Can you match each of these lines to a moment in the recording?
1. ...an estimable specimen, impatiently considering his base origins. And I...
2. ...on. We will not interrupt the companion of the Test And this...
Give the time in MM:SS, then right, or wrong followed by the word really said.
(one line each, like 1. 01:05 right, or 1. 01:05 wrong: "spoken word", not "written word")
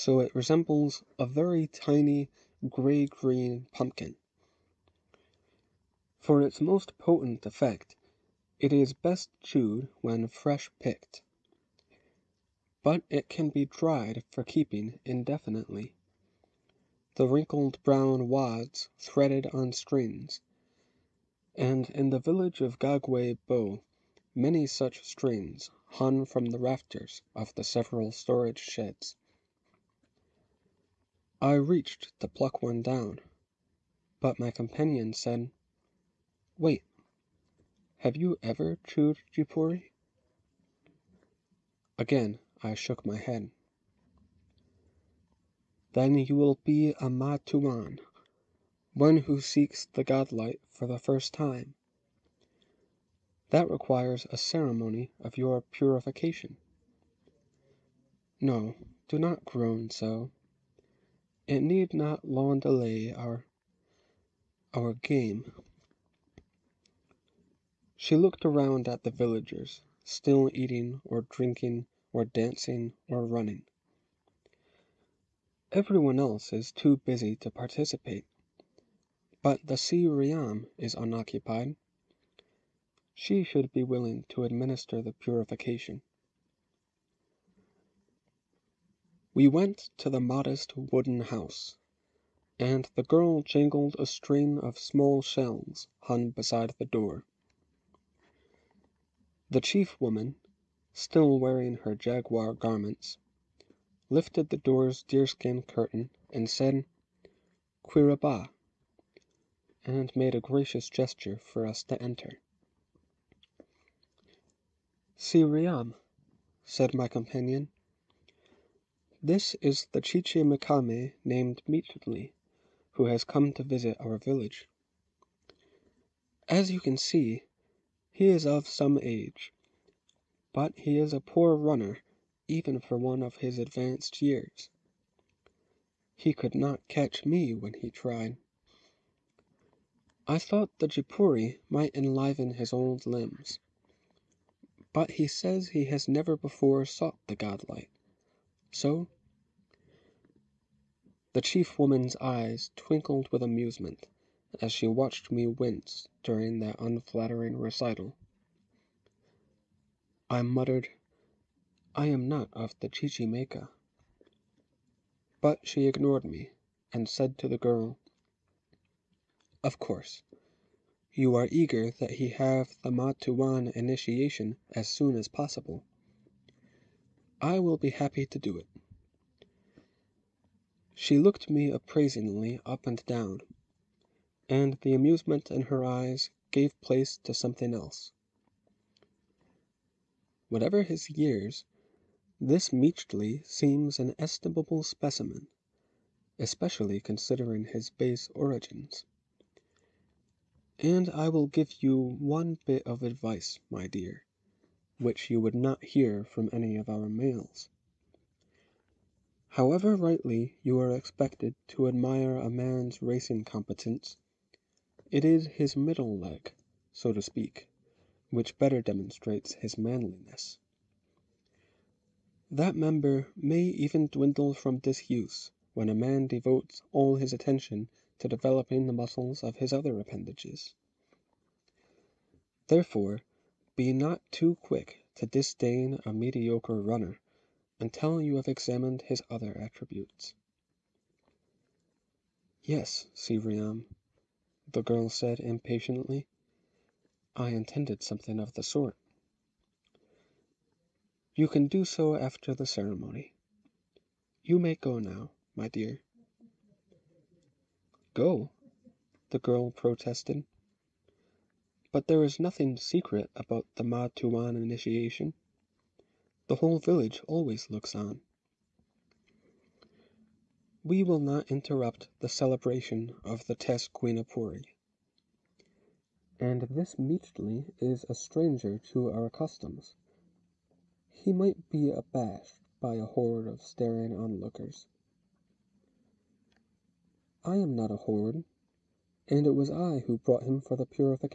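1. 03:13 wrong: "especially", not "impatiently"
2. 04:27 wrong: "celebration", not "companion".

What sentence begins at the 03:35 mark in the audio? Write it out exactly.
It is his middle leg, so to speak, which better demonstrates his manliness.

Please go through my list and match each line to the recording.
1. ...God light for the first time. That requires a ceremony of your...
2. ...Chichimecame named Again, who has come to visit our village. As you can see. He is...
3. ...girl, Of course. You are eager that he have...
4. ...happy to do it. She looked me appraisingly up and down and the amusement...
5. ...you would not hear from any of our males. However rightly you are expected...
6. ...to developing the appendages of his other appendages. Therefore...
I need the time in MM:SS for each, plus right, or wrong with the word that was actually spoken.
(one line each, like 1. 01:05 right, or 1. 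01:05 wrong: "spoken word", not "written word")
1. 00:50 right
2. 02:00 wrong: "Mixtli", not "Again"
3. 02:47 right
4. 02:57 right
5. 03:25 right
6. 03:48 wrong: "muscles", not "appendages".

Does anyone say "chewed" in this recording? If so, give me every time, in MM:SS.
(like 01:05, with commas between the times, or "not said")
00:09, 00:38.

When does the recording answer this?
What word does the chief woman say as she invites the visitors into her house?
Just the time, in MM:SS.
01:47.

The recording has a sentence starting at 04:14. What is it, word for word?
You may go now, my dear." "Go?" the girl protested.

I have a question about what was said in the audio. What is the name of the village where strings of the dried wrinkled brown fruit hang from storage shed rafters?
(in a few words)
Gagwe Bo.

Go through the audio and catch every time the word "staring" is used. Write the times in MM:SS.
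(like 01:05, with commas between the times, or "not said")
04:43.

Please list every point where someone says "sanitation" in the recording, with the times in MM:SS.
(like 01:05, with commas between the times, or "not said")
not said.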